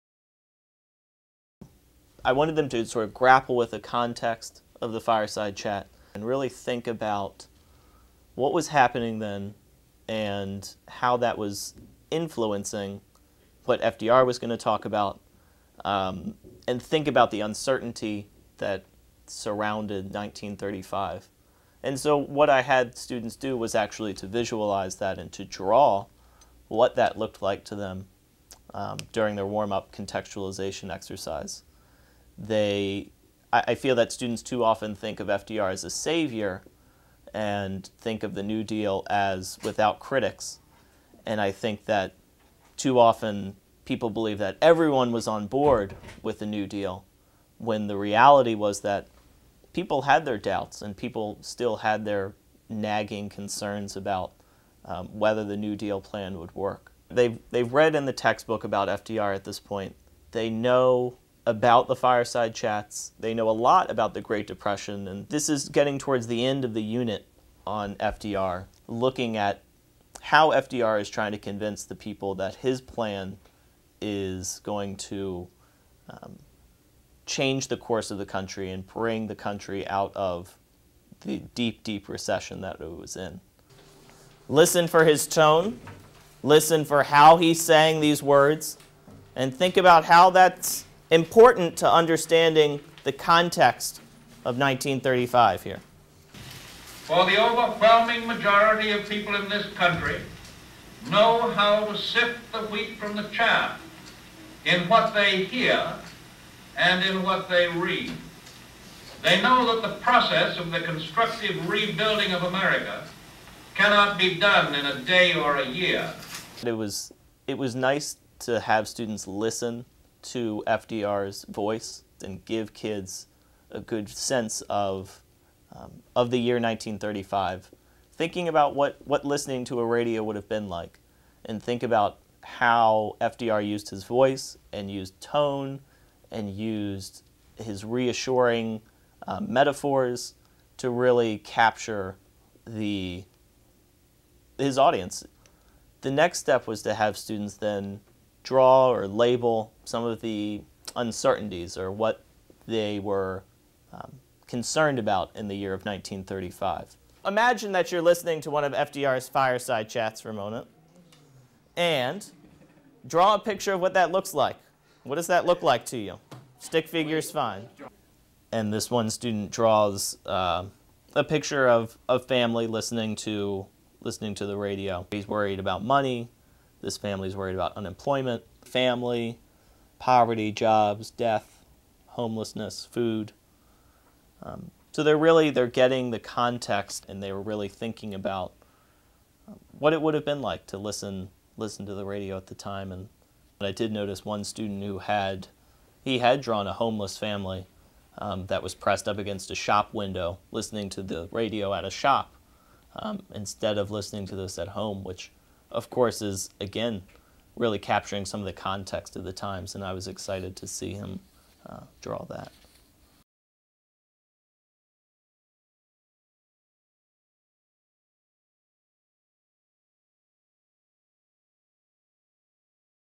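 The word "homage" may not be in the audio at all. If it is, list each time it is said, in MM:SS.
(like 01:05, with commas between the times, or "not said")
not said.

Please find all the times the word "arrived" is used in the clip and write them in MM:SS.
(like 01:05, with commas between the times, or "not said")
not said.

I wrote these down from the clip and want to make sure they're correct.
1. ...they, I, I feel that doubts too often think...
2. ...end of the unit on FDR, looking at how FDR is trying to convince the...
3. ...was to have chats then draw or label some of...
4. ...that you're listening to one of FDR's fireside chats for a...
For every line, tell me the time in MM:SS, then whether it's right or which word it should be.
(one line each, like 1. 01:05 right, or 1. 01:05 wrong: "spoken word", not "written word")
1. 00:32 wrong: "students", not "doubts"
2. 01:06 right
3. 02:26 wrong: "students", not "chats"
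4. 02:37 right.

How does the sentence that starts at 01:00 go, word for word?
They know about the fireside chats.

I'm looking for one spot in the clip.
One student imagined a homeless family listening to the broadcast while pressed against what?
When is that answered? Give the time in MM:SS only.
03:19.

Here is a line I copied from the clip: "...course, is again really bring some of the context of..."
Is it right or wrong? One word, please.
wrong.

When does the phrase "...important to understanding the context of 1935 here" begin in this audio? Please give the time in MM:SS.
01:31.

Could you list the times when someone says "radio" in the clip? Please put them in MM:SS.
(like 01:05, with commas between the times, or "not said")
02:09, 02:54, 03:12, 03:21.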